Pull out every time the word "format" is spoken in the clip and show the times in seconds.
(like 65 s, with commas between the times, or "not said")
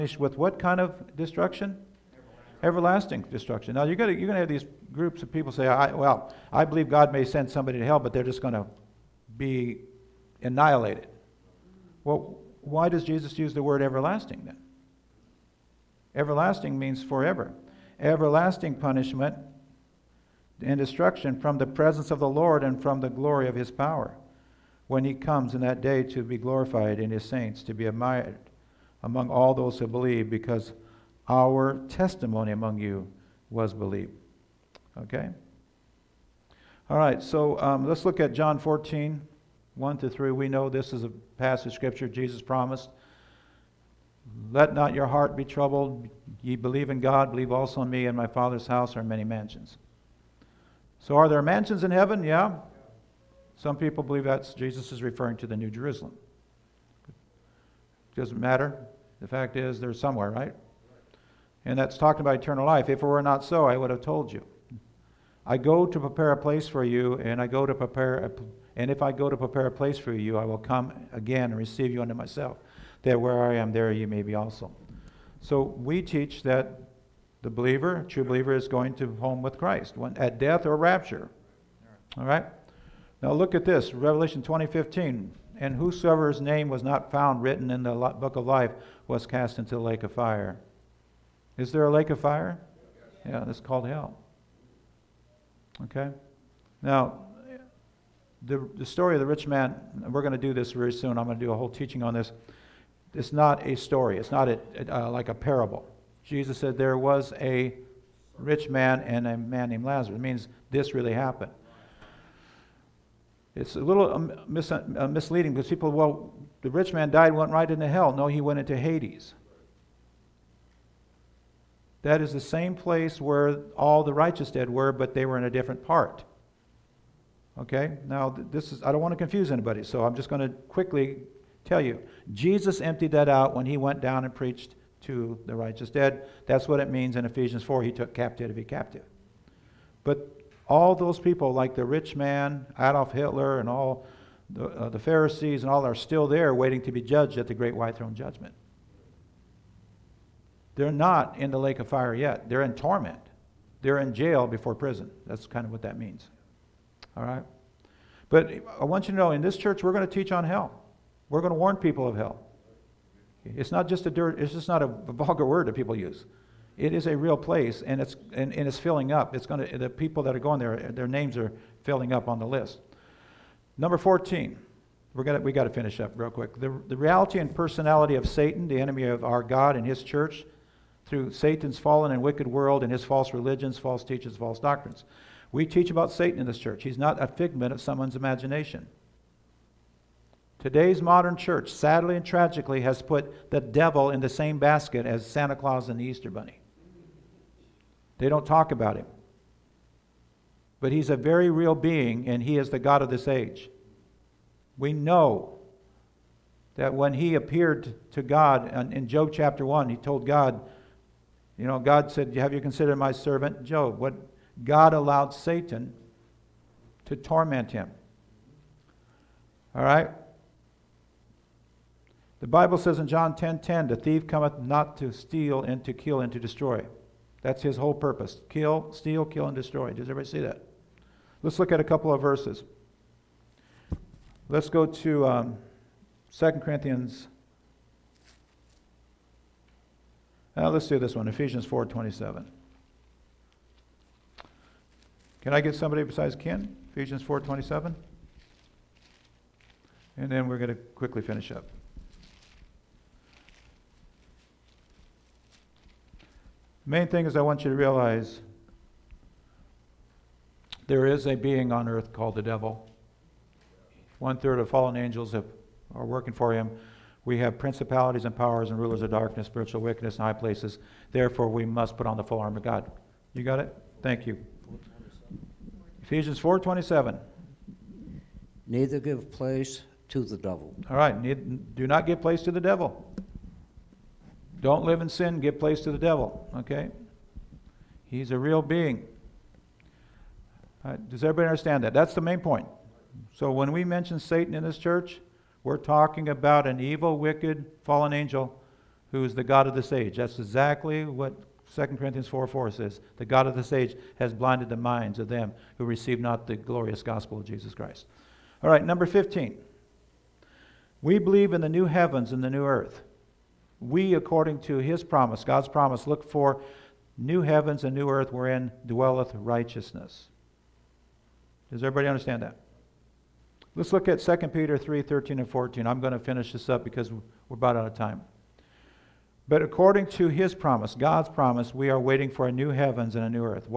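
not said.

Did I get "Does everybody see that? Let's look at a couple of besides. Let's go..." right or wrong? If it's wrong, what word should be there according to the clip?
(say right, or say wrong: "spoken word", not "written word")
wrong: "verses", not "besides".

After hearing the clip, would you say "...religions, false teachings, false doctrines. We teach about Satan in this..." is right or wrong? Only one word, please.
right.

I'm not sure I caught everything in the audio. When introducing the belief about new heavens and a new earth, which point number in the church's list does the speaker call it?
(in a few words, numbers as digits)
15.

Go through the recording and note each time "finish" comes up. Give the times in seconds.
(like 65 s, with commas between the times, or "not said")
175 s, 251 s, 326 s.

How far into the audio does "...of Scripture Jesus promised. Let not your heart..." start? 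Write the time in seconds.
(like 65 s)
41 s.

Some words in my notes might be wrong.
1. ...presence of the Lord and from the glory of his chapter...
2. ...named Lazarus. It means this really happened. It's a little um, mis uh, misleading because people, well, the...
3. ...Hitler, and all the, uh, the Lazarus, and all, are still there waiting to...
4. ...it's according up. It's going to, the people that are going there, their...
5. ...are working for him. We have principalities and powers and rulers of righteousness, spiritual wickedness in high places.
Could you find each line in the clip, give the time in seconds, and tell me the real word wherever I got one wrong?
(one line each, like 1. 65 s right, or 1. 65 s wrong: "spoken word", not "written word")
1. 21 s wrong: "power", not "chapter"
2. 109 s right
3. 143 s wrong: "Pharisees", not "Lazarus"
4. 168 s wrong: "filling", not "according"
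5. 265 s wrong: "darkness", not "righteousness".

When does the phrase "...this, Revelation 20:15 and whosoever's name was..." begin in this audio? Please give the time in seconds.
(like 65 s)
83 s.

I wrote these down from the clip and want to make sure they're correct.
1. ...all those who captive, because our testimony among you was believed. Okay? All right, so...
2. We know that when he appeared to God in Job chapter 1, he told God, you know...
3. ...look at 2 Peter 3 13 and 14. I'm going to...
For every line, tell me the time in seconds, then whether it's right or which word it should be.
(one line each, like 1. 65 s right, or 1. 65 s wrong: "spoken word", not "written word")
1. 29 s wrong: "believe", not "captive"
2. 204 s right
3. 323 s right.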